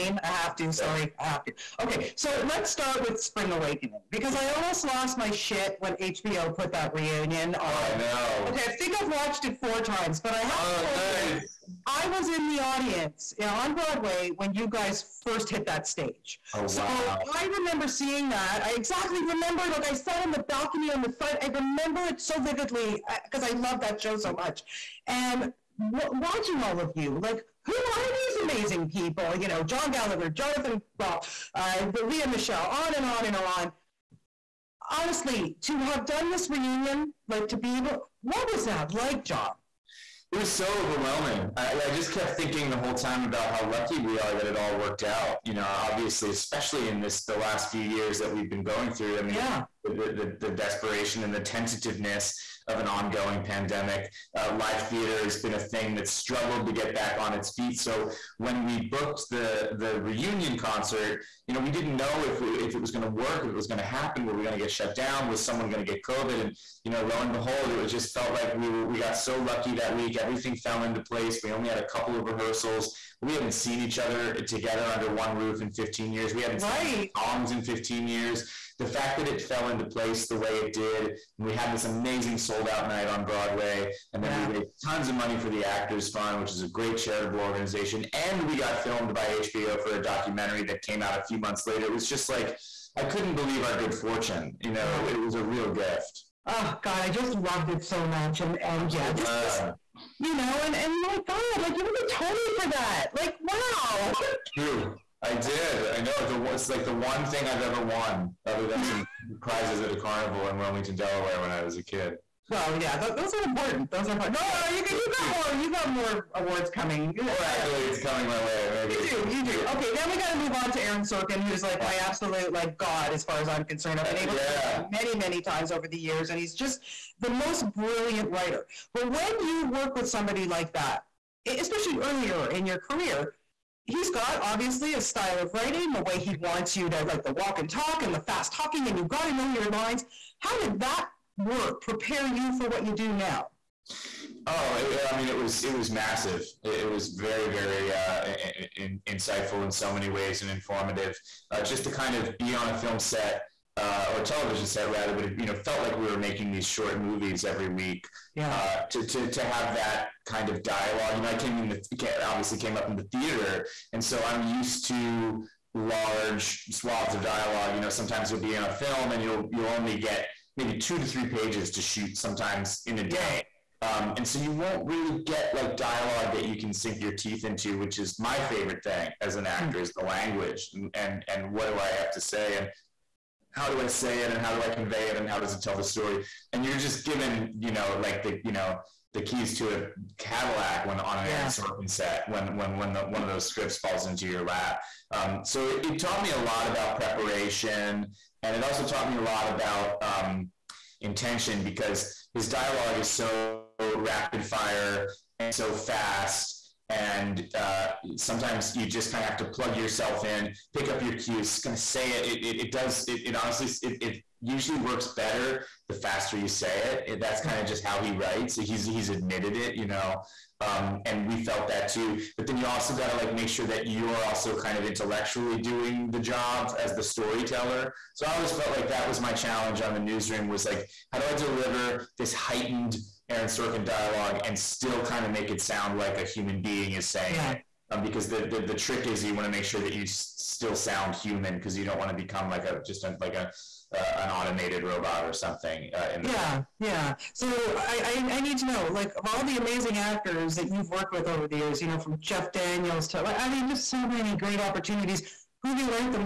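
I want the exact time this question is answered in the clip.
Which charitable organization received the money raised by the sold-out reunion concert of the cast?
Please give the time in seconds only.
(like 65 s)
85 s.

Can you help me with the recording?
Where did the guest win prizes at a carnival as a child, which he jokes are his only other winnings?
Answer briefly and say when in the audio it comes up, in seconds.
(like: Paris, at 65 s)
Wilmington, Delaware, at 110 s.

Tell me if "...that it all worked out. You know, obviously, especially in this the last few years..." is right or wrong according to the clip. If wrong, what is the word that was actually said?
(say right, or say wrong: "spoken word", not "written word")
right.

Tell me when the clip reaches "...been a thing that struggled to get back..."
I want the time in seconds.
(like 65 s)
55 s.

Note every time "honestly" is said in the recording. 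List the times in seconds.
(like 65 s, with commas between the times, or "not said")
34 s, 213 s.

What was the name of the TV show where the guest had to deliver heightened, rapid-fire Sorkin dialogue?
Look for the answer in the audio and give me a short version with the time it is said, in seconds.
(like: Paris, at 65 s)
The Newsroom, at 229 s.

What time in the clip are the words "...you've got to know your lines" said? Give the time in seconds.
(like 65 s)
138 s.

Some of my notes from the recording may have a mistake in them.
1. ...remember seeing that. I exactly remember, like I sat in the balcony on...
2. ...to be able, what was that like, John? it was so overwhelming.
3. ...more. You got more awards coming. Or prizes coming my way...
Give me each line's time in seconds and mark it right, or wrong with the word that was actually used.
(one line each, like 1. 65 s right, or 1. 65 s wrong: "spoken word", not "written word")
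1. 17 s right
2. 37 s right
3. 115 s wrong: "accolades", not "prizes".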